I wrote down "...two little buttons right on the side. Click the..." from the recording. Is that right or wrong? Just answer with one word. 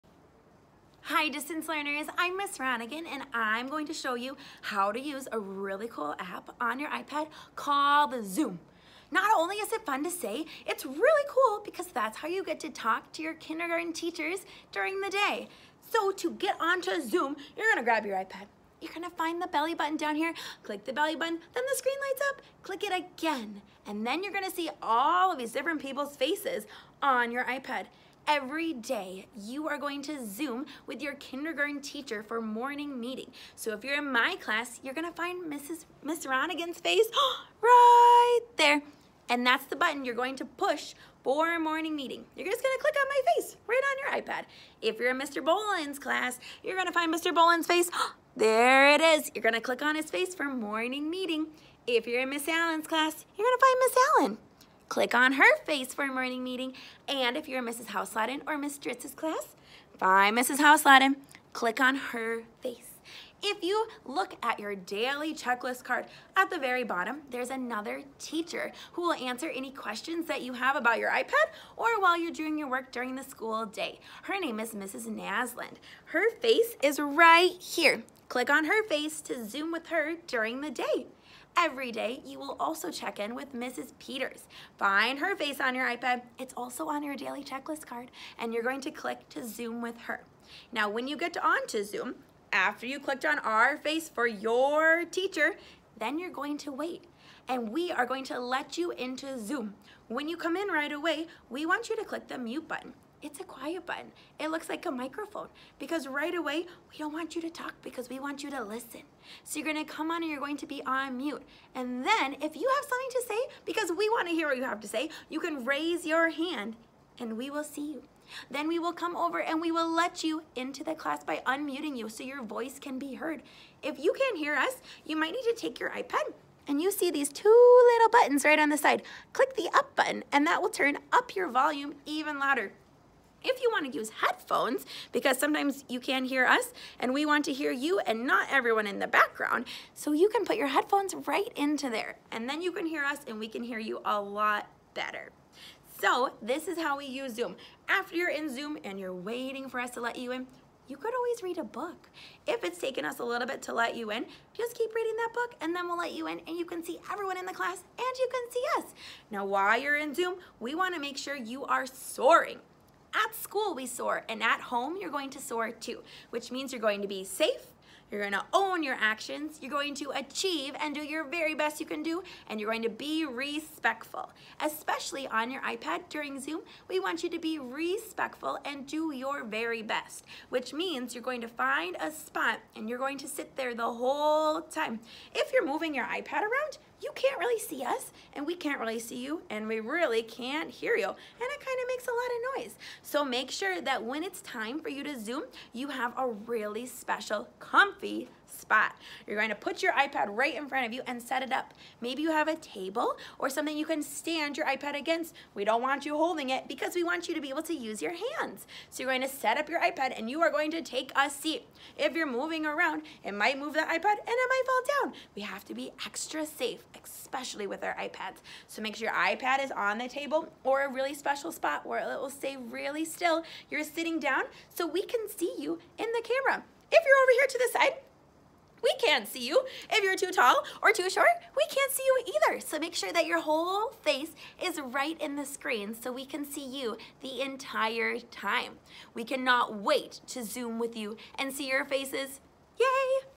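right.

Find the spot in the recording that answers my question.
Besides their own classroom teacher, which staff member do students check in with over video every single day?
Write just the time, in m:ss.
1:23.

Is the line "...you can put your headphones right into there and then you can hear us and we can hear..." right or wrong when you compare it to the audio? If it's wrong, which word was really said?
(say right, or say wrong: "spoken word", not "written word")
right.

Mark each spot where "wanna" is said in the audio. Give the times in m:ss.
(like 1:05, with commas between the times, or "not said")
1:54, 2:40.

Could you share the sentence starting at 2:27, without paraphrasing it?
After you're in Zoom and you're waiting for us to let you in, you could always read a book.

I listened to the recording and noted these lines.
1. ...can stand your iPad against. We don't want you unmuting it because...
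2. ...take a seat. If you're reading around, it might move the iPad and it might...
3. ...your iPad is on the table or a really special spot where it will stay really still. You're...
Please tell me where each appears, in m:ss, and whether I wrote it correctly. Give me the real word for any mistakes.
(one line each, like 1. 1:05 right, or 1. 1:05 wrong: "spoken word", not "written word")
1. 3:23 wrong: "holding", not "unmuting"
2. 3:30 wrong: "moving", not "reading"
3. 3:39 right.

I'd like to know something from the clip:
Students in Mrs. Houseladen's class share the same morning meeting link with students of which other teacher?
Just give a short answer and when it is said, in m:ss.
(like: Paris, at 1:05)
Miss Dritz, at 0:58.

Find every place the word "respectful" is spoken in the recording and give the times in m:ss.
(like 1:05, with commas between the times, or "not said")
2:53, 2:57.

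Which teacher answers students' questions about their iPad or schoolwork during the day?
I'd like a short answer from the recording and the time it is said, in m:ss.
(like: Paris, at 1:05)
Mrs. Nasland, at 1:14.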